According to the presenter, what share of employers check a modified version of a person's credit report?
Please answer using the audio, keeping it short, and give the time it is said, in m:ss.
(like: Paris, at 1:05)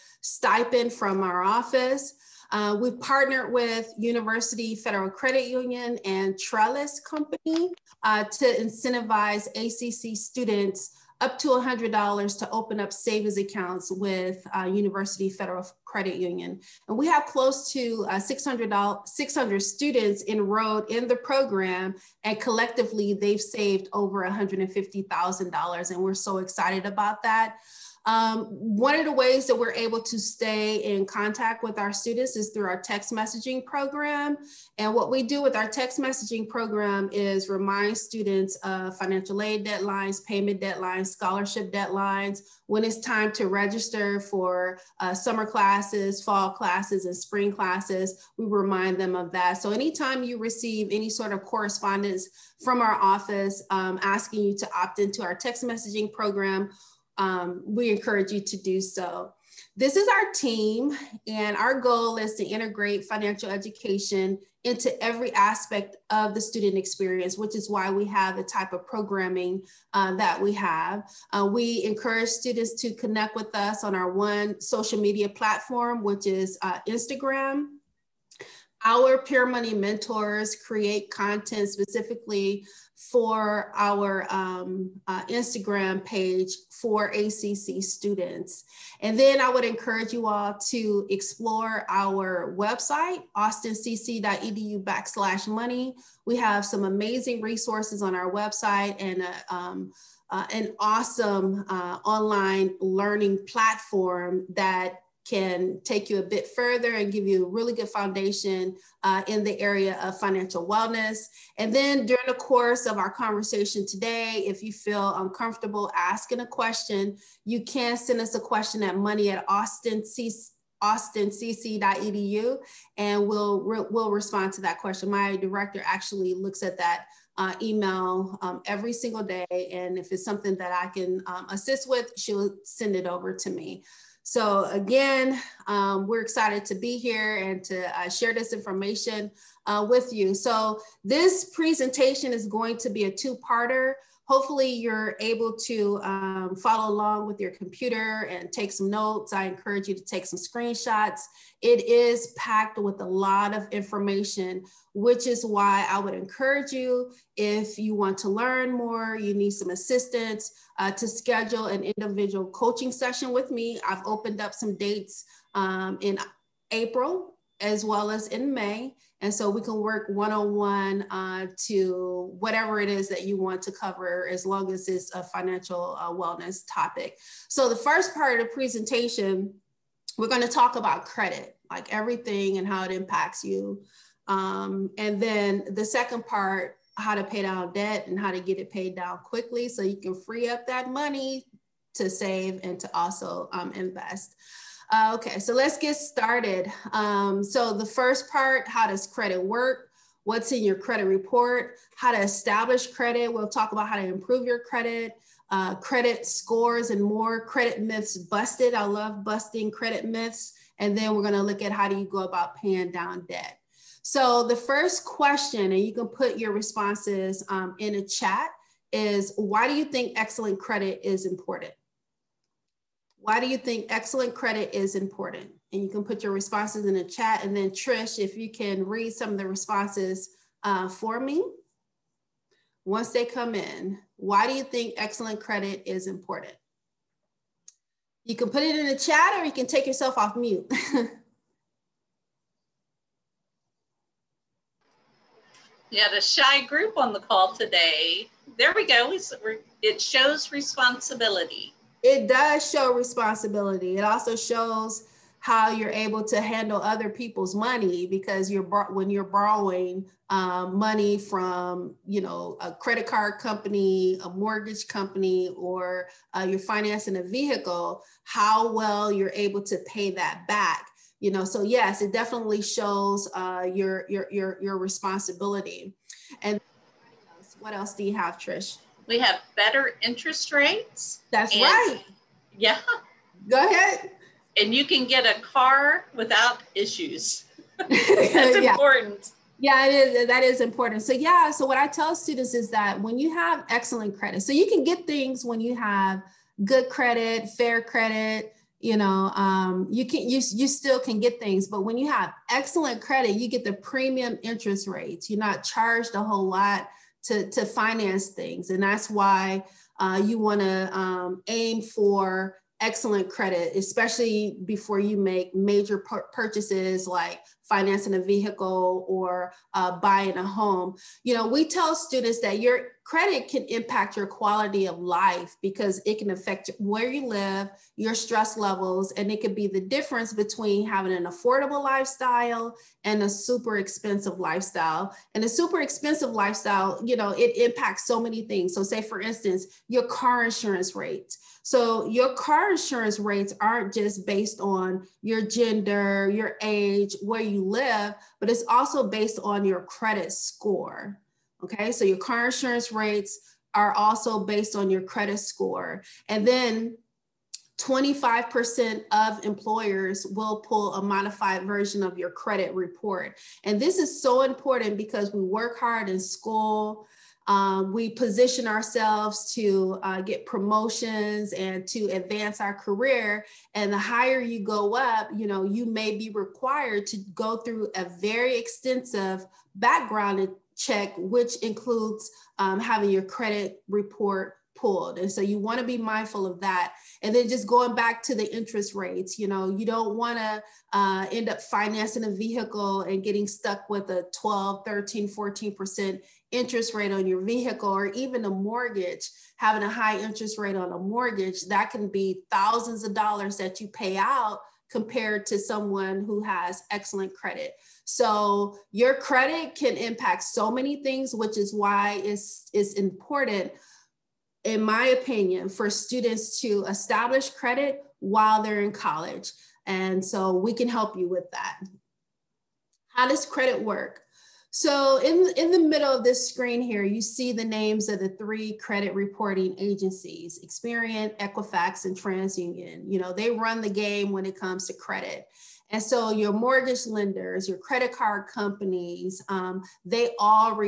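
25%, at 5:57.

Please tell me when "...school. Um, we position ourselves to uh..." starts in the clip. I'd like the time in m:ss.
6:06.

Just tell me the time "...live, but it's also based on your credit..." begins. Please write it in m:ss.
5:47.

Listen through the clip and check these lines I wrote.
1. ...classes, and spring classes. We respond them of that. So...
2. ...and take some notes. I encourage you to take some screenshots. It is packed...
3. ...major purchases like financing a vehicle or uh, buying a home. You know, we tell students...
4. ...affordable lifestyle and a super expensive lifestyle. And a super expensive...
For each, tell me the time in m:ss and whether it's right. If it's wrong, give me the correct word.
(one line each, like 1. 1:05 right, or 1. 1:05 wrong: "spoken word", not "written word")
1. 0:46 wrong: "remind", not "respond"
2. 2:28 right
3. 5:15 right
4. 5:31 right.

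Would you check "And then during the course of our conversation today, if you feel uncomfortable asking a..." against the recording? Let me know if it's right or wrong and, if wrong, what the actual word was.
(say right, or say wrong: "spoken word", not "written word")
right.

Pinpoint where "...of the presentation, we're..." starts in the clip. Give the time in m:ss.
2:58.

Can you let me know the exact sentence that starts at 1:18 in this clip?
Our peer money mentors create content specifically for our um, uh, Instagram page for ACC students.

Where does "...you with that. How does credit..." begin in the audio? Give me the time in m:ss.
7:01.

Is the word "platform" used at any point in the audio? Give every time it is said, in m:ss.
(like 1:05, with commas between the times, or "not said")
1:15, 1:43.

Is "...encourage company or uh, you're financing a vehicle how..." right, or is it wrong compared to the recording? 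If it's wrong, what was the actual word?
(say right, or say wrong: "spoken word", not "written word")
wrong: "mortgage", not "encourage".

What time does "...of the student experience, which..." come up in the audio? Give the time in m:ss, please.
1:06.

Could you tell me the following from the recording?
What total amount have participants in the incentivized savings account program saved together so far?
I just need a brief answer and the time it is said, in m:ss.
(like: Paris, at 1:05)
$150,000, at 0:24.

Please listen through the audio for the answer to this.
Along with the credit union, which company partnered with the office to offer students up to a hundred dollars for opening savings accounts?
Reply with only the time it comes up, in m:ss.
0:06.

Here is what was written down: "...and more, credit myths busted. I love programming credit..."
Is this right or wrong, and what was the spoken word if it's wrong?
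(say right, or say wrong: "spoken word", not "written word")
wrong: "busting", not "programming".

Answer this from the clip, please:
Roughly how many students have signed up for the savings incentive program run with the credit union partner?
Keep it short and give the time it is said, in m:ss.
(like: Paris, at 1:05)
600, at 0:19.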